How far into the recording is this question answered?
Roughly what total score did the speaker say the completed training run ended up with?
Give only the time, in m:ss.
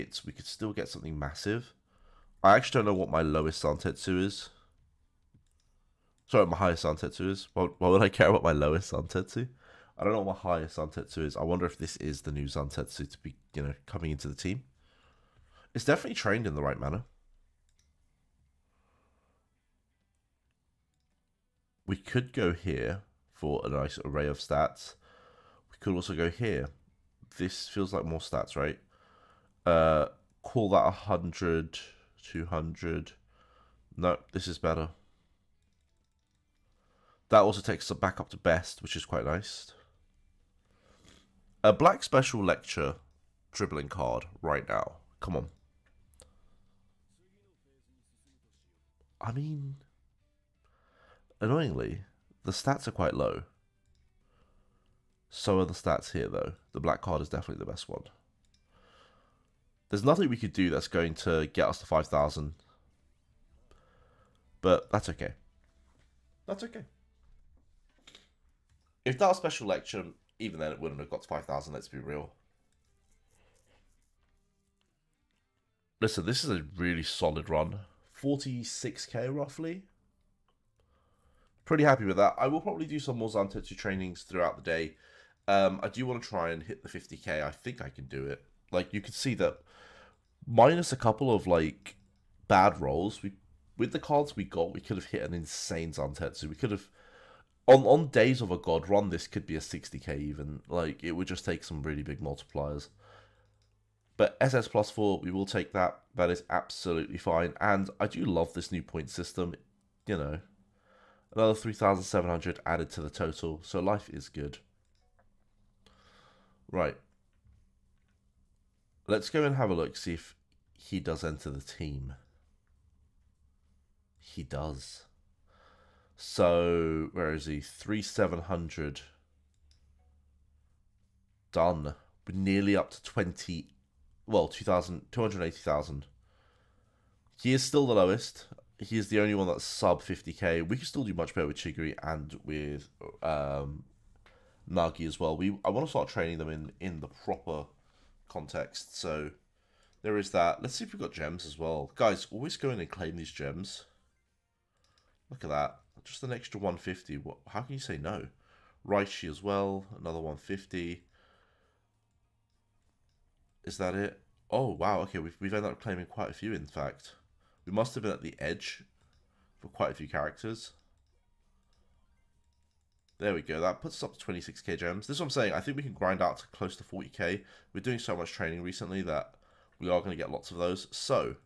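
1:18.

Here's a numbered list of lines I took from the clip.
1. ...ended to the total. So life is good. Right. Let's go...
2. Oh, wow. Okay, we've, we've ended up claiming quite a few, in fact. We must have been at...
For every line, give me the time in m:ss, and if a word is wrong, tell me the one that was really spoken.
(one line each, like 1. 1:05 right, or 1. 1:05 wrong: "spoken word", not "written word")
1. 1:52 wrong: "added", not "ended"
2. 2:44 right.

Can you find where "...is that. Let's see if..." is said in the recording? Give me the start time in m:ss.
2:30.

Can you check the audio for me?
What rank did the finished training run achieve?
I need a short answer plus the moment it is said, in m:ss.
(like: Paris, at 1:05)
SS plus four, at 1:44.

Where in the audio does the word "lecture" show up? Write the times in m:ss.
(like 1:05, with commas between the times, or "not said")
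0:42, 1:09.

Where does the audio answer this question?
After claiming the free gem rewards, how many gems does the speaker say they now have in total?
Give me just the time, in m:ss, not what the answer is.
2:54.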